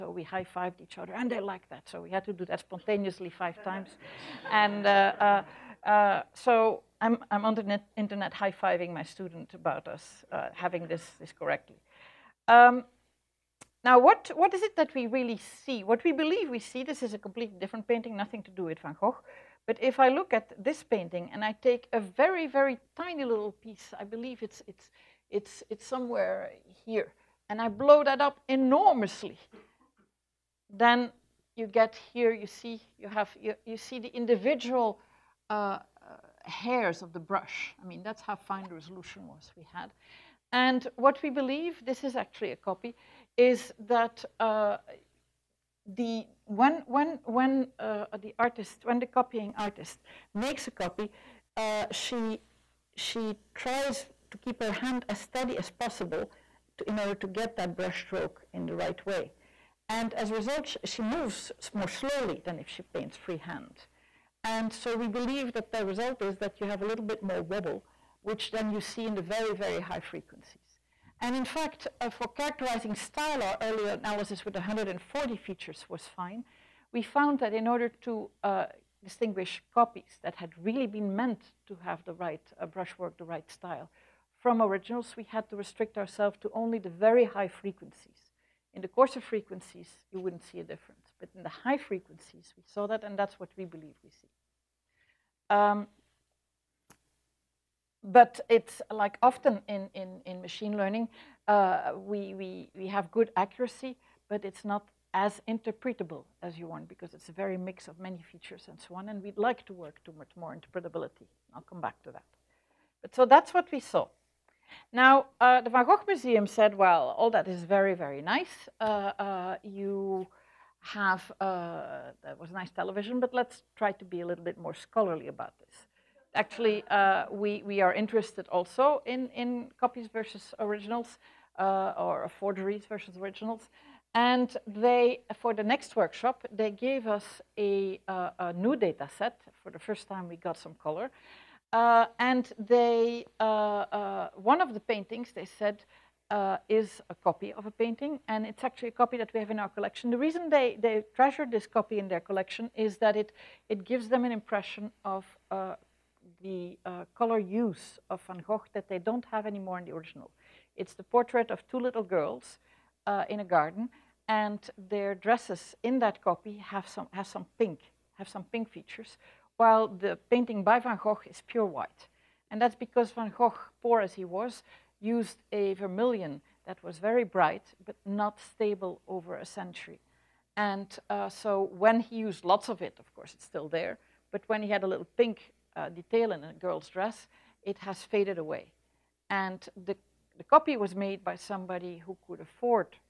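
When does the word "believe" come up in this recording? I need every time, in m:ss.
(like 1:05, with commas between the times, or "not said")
0:16, 0:24, 0:41, 1:05, 1:33.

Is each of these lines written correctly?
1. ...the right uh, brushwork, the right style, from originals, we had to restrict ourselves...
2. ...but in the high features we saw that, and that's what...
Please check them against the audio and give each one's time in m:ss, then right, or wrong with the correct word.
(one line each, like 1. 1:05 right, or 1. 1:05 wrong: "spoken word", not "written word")
1. 1:22 right
2. 1:31 wrong: "frequencies", not "features".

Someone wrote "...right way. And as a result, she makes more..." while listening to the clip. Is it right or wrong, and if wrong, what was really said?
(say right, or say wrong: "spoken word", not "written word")
wrong: "moves", not "makes".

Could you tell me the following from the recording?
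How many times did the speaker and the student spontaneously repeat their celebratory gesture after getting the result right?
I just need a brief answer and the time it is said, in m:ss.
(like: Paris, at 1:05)
5, at 0:03.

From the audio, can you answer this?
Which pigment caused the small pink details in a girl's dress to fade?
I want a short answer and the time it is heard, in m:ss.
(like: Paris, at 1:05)
Vermilion, at 2:55.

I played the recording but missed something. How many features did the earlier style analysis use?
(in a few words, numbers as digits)
140.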